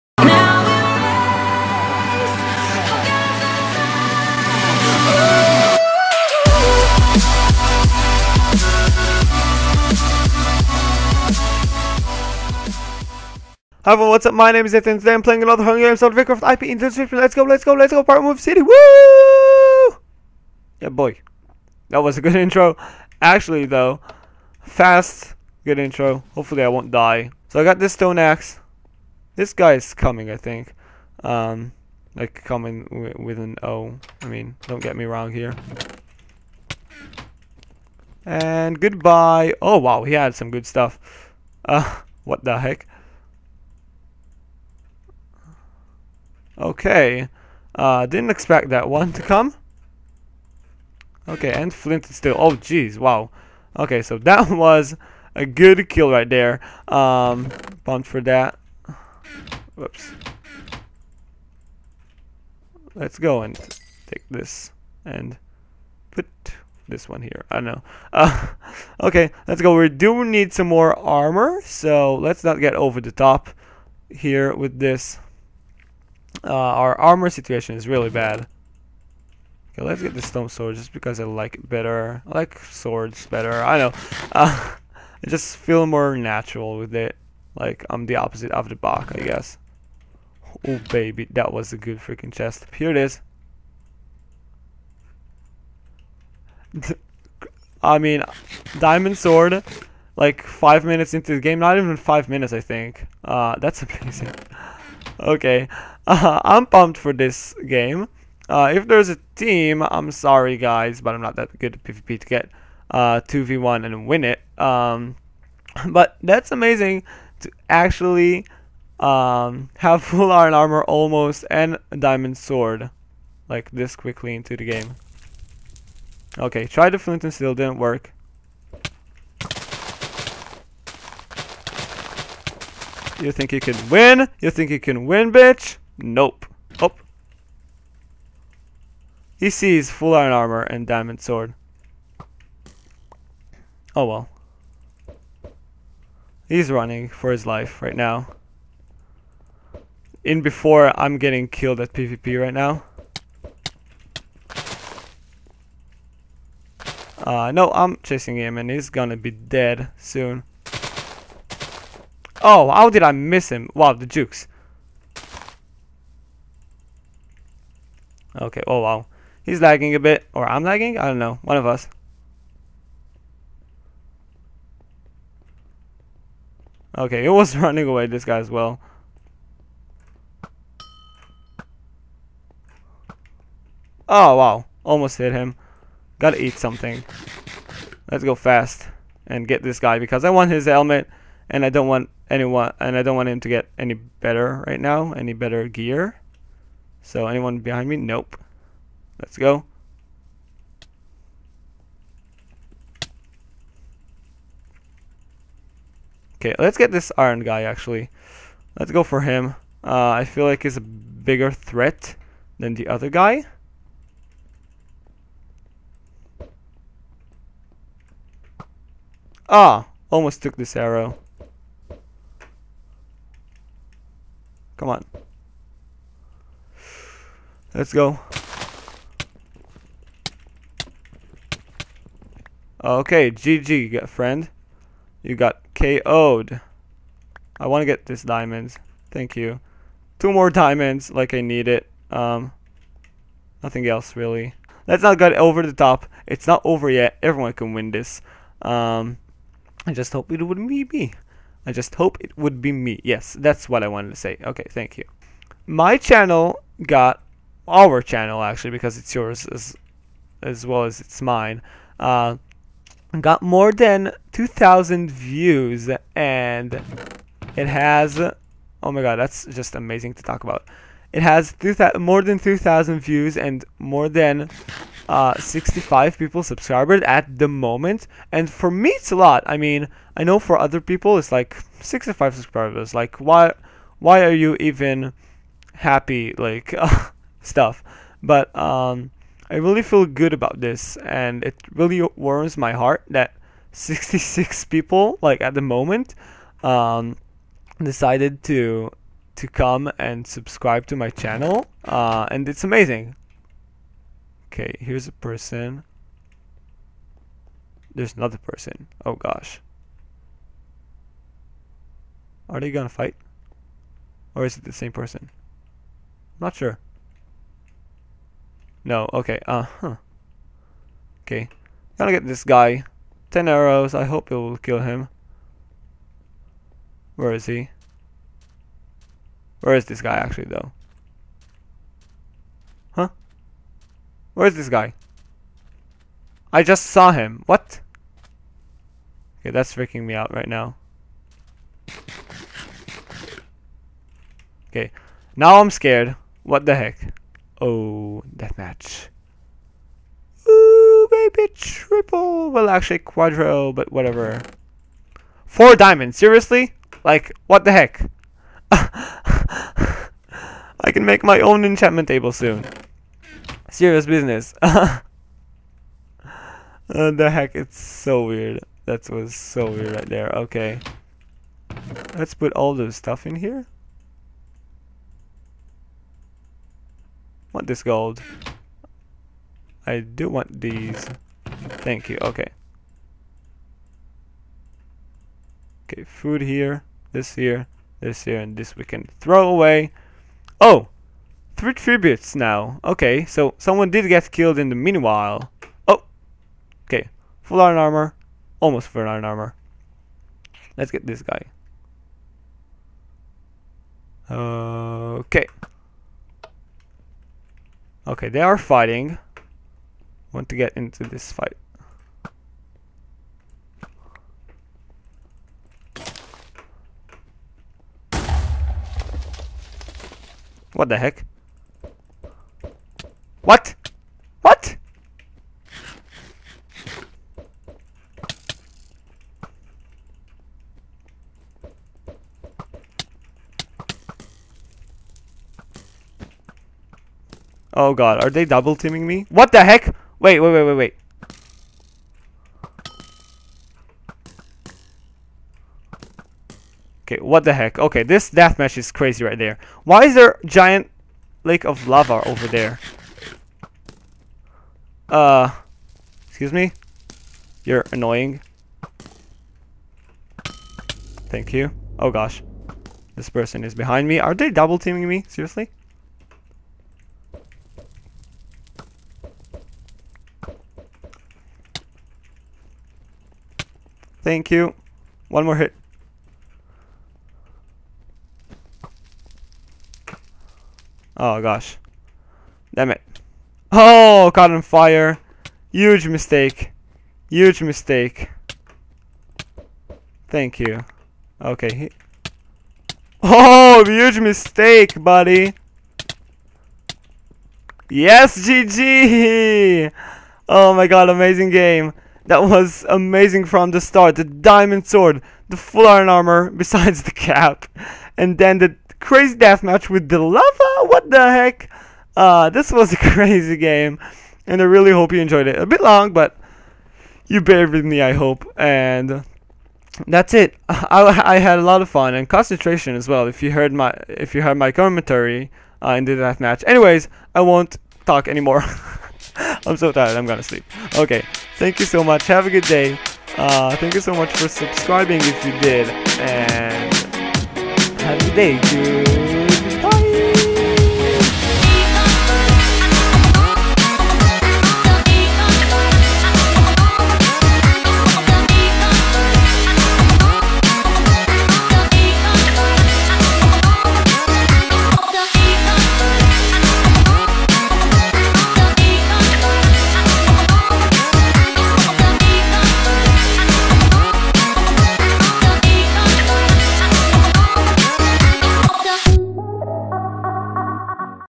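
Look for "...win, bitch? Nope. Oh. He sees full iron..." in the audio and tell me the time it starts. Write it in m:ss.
2:15.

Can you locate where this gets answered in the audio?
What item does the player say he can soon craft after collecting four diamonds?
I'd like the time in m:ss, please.
6:01.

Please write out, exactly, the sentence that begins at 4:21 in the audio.
Uh, got more than 2,000 views and it has oh my god that's just amazing to talk about.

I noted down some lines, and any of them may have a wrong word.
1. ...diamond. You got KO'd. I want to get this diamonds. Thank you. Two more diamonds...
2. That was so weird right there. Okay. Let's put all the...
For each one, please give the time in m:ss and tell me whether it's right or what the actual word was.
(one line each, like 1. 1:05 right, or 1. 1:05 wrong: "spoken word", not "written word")
1. 3:54 wrong: "friend", not "diamond"
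2. 6:08 right.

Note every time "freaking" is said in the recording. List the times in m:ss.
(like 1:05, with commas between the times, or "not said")
1:31, 5:39.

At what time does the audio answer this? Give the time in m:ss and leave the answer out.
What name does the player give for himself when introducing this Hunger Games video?
0:14.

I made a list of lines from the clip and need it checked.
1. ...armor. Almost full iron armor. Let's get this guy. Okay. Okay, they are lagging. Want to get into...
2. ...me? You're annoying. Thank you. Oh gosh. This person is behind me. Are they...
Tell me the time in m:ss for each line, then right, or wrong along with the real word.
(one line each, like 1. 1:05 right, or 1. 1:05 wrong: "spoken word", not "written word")
1. 6:37 wrong: "fighting", not "lagging"
2. 7:36 right.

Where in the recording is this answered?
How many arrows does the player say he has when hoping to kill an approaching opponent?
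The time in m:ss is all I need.
5:23.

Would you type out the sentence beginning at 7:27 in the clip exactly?
Okay, this deathmatch is crazy right there.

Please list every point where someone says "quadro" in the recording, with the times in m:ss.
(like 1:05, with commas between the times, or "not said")
5:52.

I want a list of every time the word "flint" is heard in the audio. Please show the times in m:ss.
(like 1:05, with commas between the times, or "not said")
0:51, 2:06.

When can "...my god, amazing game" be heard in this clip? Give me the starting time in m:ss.
8:20.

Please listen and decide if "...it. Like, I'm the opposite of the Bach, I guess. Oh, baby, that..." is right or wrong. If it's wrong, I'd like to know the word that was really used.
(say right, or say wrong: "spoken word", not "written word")
right.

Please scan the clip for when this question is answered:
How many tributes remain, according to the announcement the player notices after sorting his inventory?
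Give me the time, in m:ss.
6:31.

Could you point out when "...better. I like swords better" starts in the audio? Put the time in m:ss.
1:21.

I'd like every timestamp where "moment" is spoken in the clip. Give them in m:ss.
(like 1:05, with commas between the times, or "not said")
4:37, 4:55.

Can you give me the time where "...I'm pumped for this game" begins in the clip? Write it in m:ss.
1:46.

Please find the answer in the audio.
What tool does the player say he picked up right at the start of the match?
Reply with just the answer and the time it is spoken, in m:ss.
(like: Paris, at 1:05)
stone axe, at 0:27.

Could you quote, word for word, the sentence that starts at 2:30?
In before I'm getting killed at PvP right now.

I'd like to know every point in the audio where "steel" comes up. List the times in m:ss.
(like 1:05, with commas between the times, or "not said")
2:07.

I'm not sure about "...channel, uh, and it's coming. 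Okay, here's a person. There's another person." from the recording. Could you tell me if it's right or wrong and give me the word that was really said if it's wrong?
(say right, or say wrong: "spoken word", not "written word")
wrong: "amazing", not "coming".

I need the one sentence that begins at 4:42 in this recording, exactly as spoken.
Like, why, why are you even happy?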